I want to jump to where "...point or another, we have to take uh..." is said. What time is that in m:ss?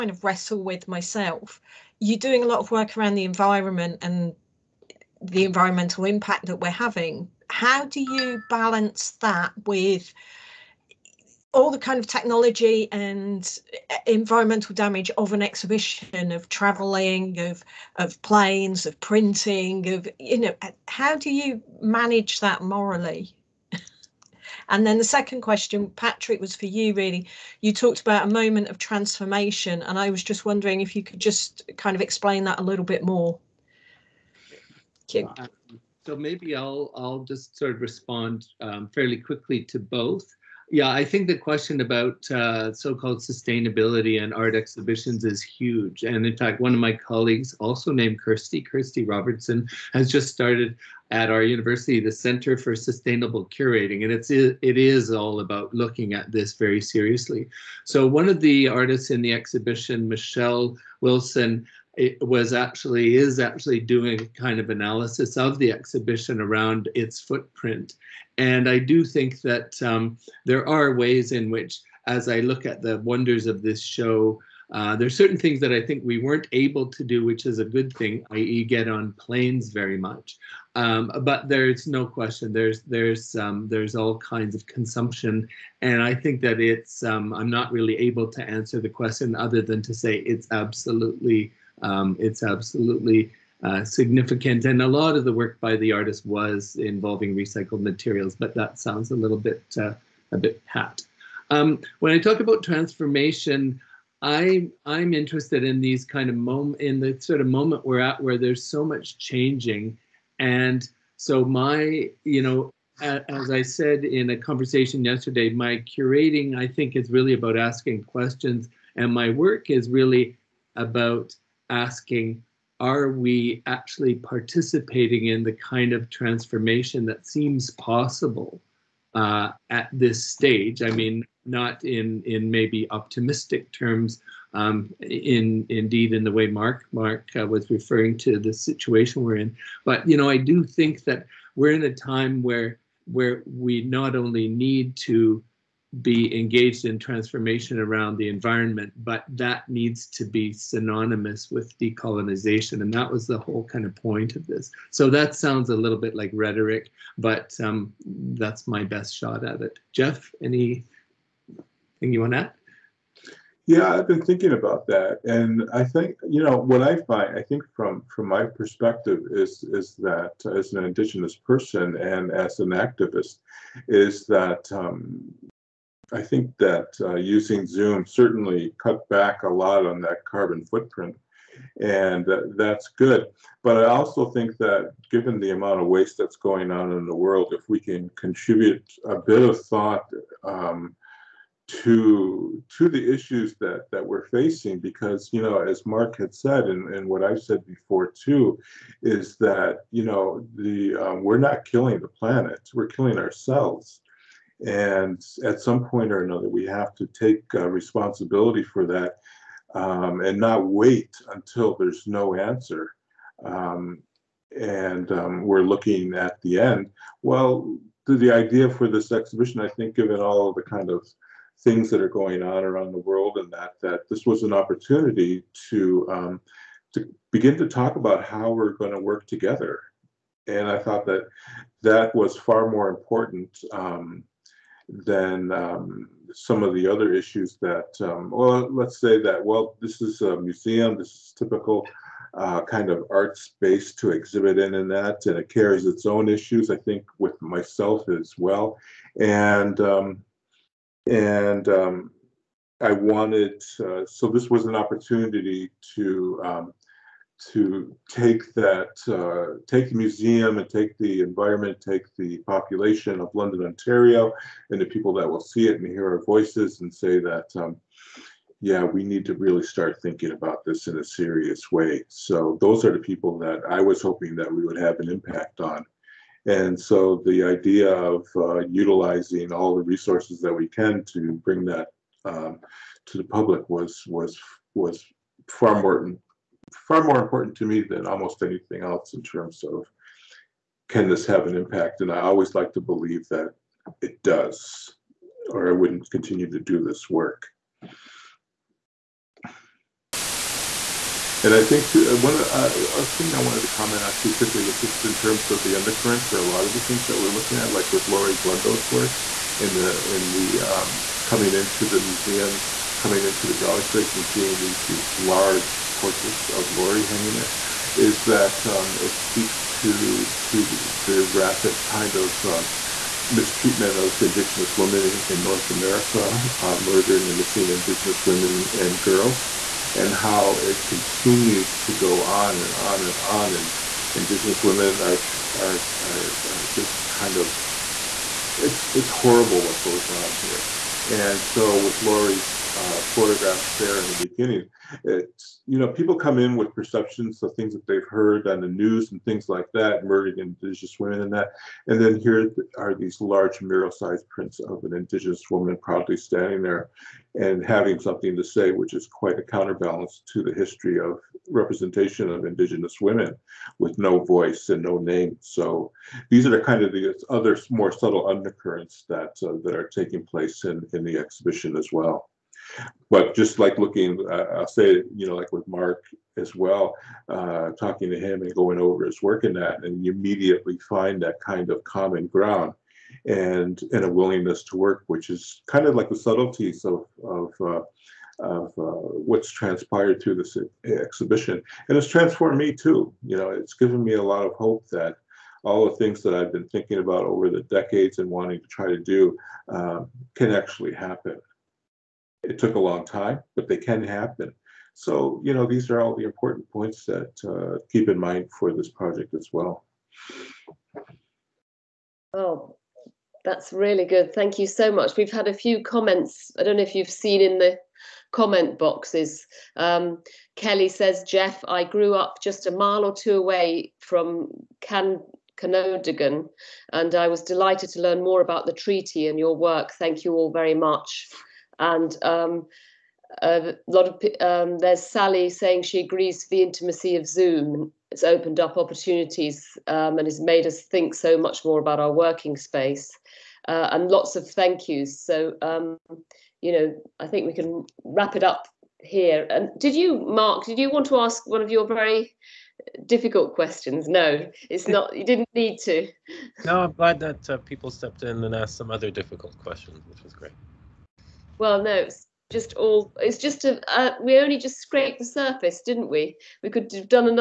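3:25.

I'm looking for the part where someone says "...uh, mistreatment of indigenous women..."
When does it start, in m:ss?
5:22.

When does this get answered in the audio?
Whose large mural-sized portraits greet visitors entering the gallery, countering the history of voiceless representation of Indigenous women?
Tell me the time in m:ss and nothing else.
5:08.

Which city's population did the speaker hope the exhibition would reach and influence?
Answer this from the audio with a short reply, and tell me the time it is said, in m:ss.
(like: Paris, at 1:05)
London, Ontario, at 4:23.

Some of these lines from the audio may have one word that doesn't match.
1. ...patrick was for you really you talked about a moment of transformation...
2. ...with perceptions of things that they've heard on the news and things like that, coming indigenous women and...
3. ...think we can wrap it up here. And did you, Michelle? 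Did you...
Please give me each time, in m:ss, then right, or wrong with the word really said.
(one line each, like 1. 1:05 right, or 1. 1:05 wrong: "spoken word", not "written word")
1. 0:25 right
2. 5:46 wrong: "murdering", not "coming"
3. 7:27 wrong: "Mark", not "Michelle".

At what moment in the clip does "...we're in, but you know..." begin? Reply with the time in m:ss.
2:19.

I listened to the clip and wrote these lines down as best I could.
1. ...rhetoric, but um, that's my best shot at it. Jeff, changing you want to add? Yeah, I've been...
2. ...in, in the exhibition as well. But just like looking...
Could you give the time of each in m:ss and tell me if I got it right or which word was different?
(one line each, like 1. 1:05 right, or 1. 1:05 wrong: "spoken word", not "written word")
1. 2:36 wrong: "anything", not "changing"
2. 6:10 right.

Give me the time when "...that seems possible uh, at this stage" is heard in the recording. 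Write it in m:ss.
2:07.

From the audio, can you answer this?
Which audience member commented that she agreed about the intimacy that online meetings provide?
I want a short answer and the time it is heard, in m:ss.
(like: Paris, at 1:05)
Sally, at 7:15.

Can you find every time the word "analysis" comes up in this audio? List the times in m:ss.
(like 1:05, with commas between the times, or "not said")
1:04.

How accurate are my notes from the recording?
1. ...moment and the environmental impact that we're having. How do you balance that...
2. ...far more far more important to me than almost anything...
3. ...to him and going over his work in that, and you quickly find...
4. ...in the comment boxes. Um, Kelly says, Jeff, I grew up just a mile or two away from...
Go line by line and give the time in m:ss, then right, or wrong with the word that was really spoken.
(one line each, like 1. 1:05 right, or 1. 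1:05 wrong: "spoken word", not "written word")
1. 0:03 wrong: "environment", not "moment"
2. 4:45 right
3. 6:18 wrong: "immediately", not "quickly"
4. 6:57 right.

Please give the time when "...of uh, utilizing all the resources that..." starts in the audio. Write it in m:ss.
4:37.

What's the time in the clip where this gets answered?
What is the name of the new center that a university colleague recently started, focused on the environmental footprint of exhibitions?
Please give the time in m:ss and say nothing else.
0:52.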